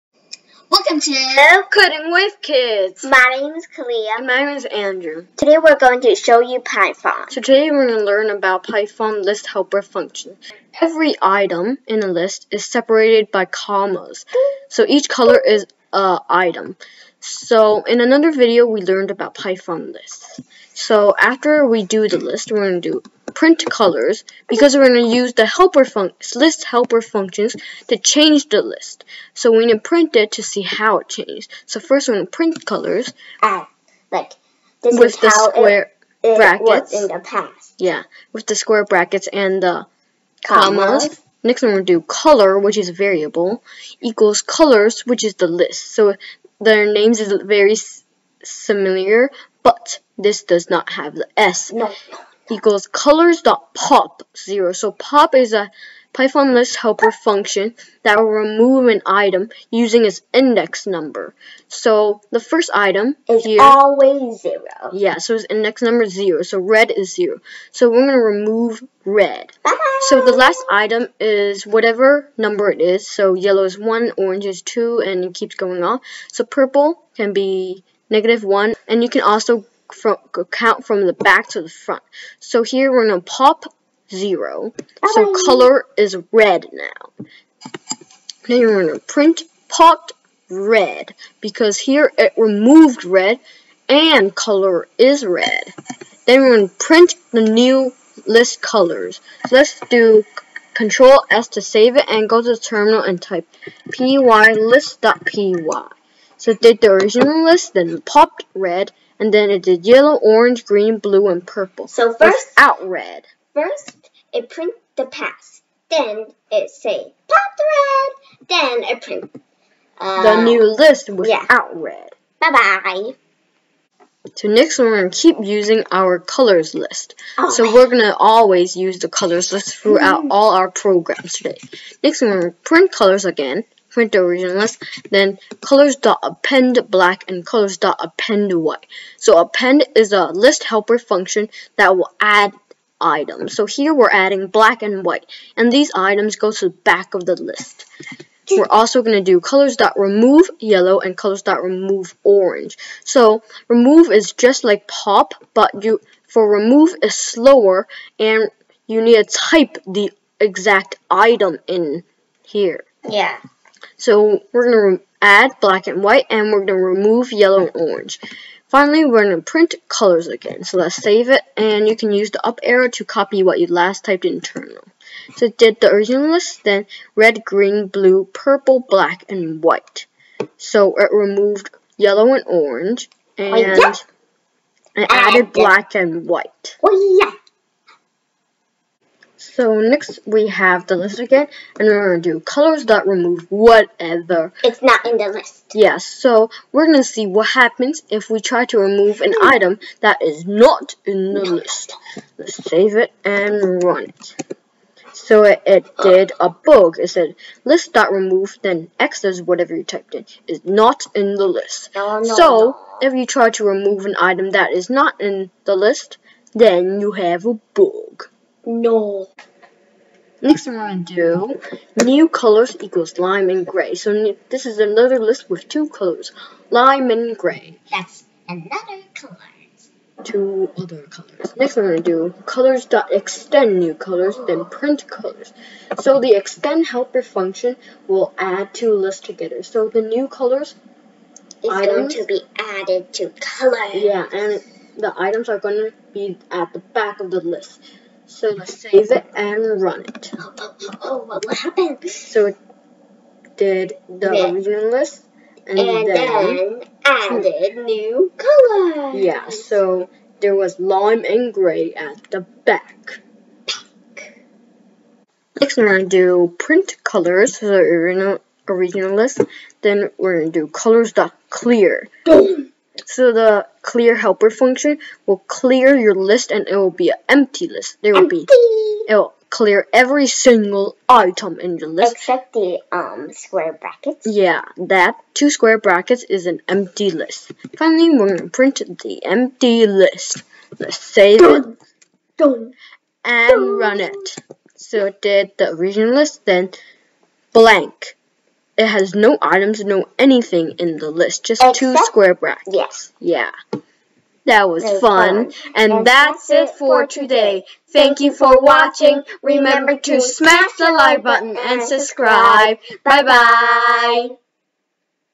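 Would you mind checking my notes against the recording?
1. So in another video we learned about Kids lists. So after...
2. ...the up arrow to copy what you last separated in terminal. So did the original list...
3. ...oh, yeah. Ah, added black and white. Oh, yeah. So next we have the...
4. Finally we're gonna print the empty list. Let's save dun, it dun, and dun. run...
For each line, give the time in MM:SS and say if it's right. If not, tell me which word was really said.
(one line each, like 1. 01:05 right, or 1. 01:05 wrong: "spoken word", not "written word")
1. 00:17 wrong: "Python", not "Kids"
2. 02:52 wrong: "typed", not "separated"
3. 03:03 right
4. 04:47 right.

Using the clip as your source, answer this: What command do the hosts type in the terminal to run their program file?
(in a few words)
py list.py.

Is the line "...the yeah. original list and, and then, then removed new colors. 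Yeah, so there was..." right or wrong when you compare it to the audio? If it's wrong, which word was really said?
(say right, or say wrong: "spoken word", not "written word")
wrong: "added", not "removed".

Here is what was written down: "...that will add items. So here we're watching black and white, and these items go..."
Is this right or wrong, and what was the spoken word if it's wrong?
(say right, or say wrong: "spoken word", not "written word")
wrong: "adding", not "watching".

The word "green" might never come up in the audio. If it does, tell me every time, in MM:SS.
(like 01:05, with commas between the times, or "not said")
01:50, 02:57.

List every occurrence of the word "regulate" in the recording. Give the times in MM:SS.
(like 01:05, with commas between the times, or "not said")
not said.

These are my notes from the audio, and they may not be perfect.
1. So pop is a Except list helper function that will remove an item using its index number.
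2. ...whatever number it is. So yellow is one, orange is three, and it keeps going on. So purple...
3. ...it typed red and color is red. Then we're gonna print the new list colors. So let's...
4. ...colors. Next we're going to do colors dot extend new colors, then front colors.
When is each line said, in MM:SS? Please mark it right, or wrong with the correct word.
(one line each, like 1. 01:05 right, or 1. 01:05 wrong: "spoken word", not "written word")
1. 00:54 wrong: "Python", not "Except"
2. 01:11 wrong: "two", not "three"
3. 01:32 wrong: "removed", not "typed"
4. 03:51 wrong: "print", not "front".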